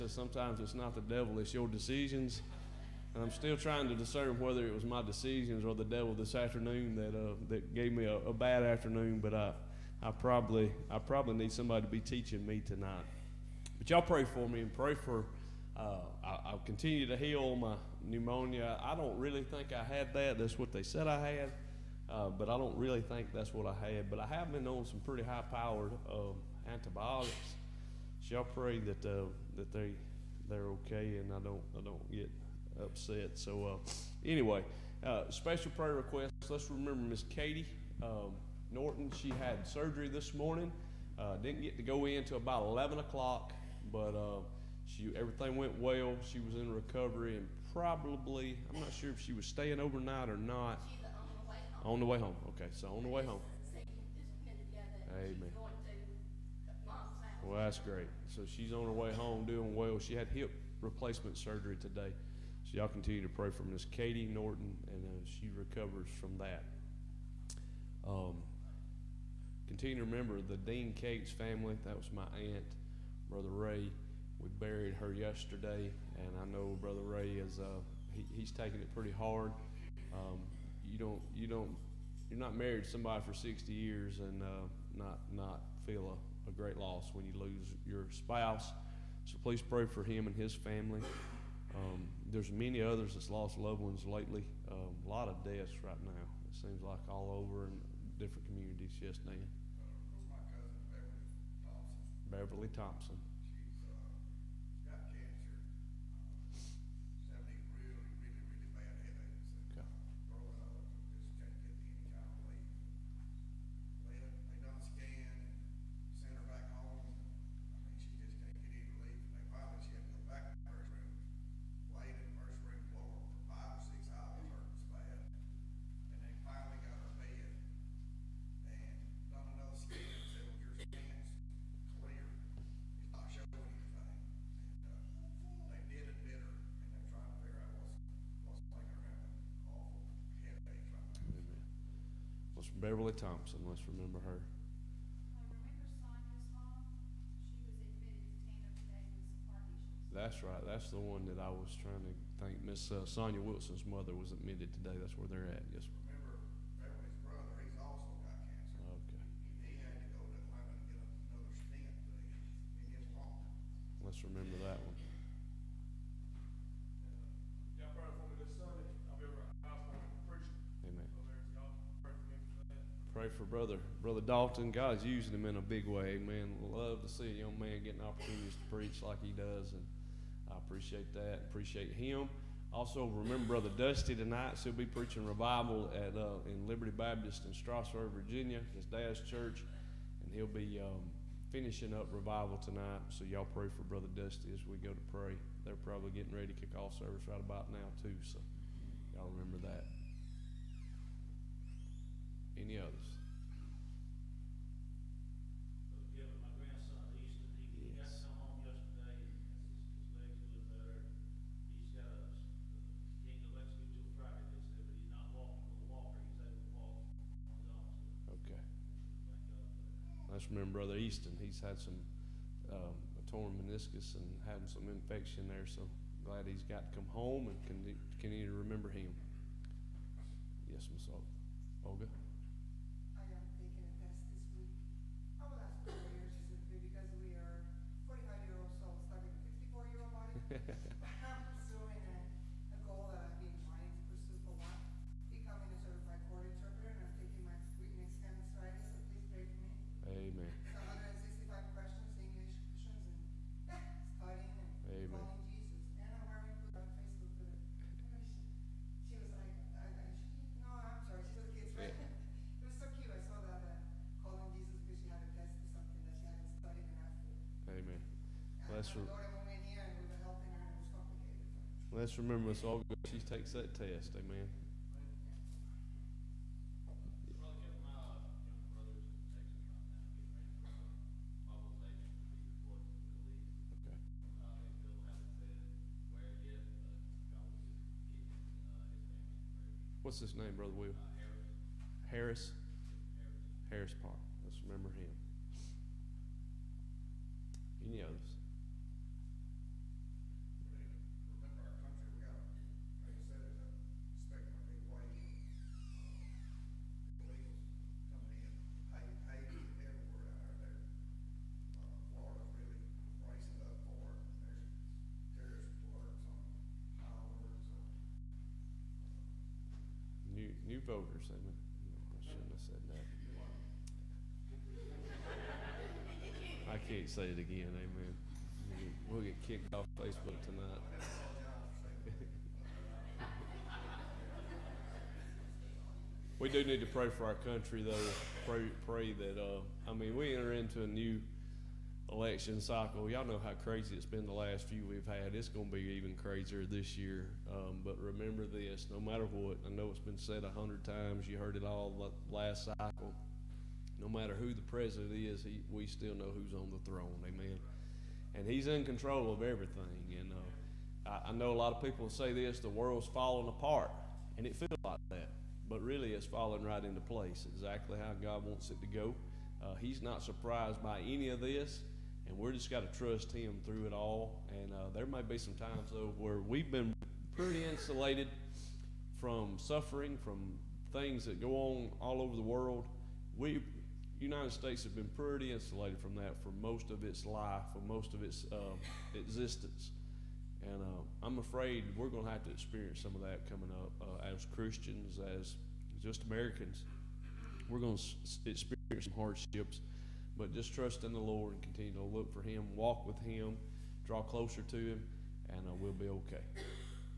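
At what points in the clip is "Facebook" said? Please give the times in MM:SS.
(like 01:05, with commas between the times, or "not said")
05:29.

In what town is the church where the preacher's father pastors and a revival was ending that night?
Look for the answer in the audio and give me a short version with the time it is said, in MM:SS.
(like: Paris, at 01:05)
Strasburg, Virginia, at 03:07.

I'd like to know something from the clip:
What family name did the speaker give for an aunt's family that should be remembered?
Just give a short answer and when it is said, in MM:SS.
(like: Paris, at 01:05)
Dean Cates, at 01:10.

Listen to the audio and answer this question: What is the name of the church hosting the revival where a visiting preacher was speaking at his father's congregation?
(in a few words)
Liberty Baptist.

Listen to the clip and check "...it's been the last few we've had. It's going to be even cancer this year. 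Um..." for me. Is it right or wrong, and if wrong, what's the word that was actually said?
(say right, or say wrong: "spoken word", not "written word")
wrong: "crazier", not "cancer".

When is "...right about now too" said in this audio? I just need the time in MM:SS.
03:17.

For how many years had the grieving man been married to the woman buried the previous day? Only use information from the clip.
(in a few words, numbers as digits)
60.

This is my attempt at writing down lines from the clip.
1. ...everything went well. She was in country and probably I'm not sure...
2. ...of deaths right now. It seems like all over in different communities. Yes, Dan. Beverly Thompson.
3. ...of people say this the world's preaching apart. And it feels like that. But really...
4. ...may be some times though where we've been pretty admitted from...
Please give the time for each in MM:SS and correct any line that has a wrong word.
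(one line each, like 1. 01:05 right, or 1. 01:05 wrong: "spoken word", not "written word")
1. 00:45 wrong: "recovery", not "country"
2. 01:35 right
3. 06:01 wrong: "falling", not "preaching"
4. 06:15 wrong: "insulated", not "admitted".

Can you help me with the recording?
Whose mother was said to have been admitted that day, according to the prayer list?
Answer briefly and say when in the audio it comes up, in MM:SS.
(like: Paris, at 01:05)
Sonia Wilson, at 02:33.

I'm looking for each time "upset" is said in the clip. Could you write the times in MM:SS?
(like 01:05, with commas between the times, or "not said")
00:32.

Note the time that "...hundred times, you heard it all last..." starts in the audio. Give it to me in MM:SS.
05:50.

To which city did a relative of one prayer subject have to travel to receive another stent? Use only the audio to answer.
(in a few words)
Atlanta.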